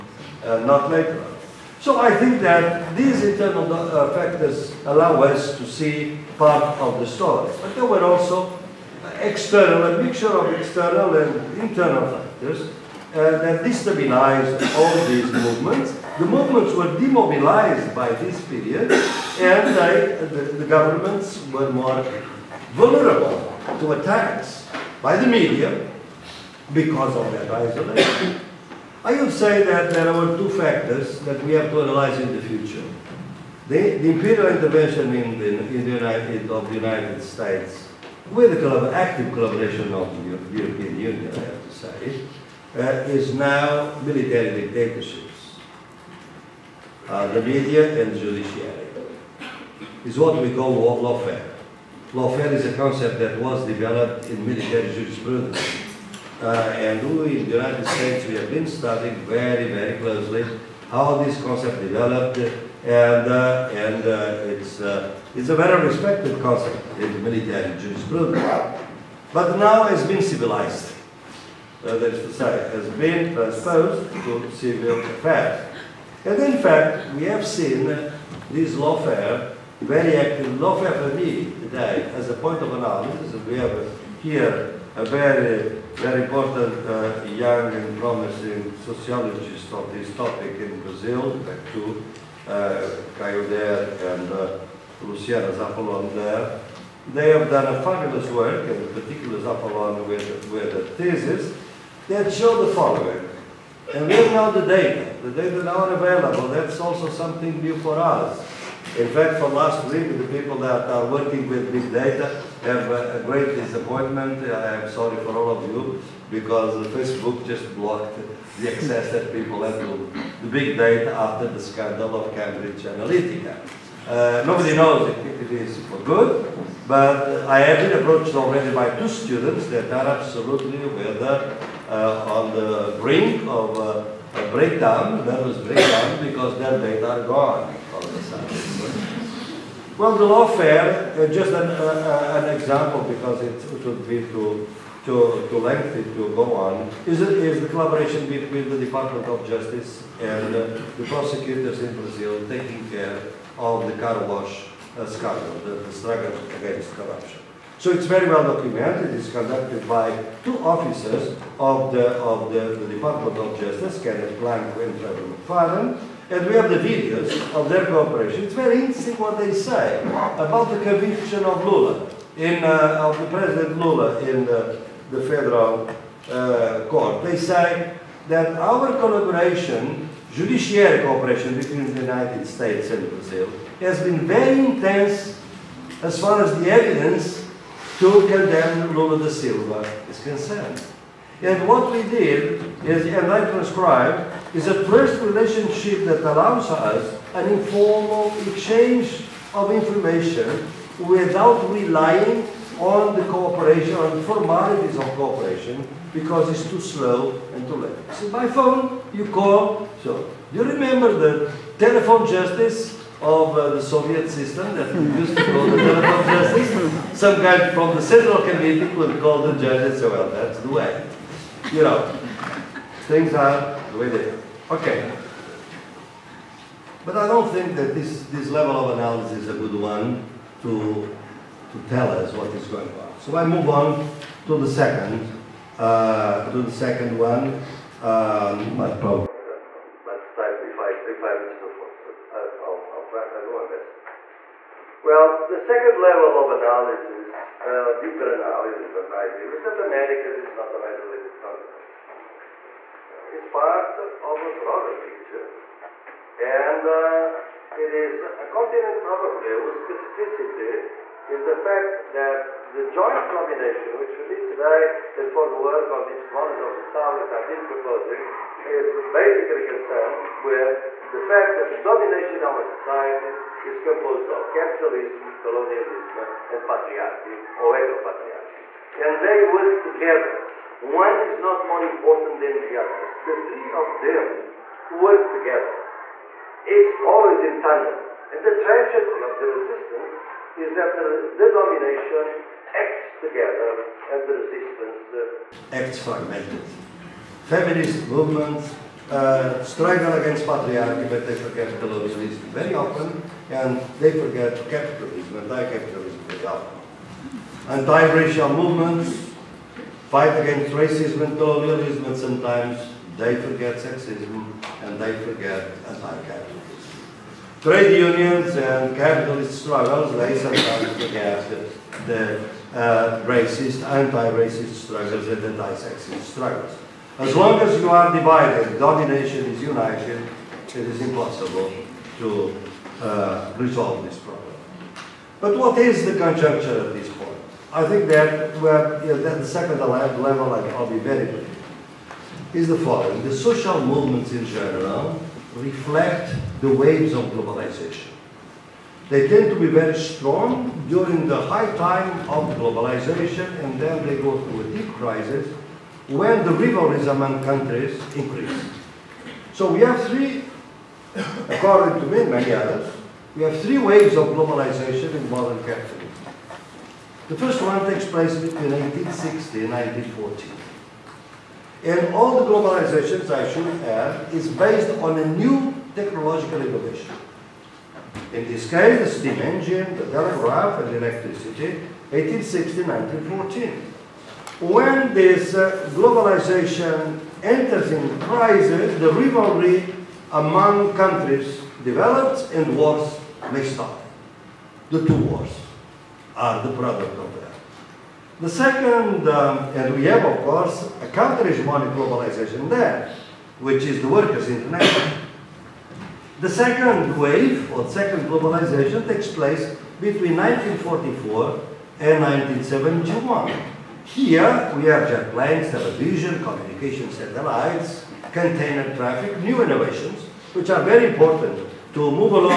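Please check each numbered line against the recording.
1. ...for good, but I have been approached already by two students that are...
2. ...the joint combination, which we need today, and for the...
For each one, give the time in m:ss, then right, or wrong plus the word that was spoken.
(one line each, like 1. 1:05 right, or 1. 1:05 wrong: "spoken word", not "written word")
1. 2:05 right
2. 4:22 right.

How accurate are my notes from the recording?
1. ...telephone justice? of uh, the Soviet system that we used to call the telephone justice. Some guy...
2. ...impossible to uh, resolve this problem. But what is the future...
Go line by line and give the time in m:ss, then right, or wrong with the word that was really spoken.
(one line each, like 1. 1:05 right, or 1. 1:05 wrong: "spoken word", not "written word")
1. 3:31 right
2. 5:31 wrong: "conjuncture", not "future".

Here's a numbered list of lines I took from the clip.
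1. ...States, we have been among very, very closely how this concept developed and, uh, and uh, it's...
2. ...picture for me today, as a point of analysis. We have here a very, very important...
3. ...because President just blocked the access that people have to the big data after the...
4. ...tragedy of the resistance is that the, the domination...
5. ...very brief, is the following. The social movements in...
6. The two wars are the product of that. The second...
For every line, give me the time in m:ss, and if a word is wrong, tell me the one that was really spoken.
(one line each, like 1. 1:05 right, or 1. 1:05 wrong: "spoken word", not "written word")
1. 0:57 wrong: "studying", not "among"
2. 1:20 wrong: "lawfare", not "picture"
3. 1:56 wrong: "Facebook", not "President"
4. 4:48 right
5. 5:40 right
6. 6:34 right.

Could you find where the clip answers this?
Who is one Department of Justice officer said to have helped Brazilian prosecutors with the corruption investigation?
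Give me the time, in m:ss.
2:44.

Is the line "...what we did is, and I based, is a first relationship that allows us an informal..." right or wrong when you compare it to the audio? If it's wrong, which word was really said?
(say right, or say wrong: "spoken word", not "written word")
wrong: "transcribed", not "based".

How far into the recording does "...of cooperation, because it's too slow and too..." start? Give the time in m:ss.
3:24.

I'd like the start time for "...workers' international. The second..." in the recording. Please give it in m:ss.
6:44.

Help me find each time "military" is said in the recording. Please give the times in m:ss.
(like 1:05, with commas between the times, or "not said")
0:44, 0:54, 1:07.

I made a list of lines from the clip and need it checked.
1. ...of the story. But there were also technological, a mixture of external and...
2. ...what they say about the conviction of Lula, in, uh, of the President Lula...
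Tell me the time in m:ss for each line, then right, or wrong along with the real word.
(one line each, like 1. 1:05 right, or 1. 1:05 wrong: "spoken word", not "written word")
1. 0:06 wrong: "external", not "technological"
2. 2:49 right.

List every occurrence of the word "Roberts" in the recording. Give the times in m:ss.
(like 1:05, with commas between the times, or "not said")
not said.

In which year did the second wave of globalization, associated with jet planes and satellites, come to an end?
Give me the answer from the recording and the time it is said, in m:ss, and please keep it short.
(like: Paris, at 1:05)
1971, at 6:52.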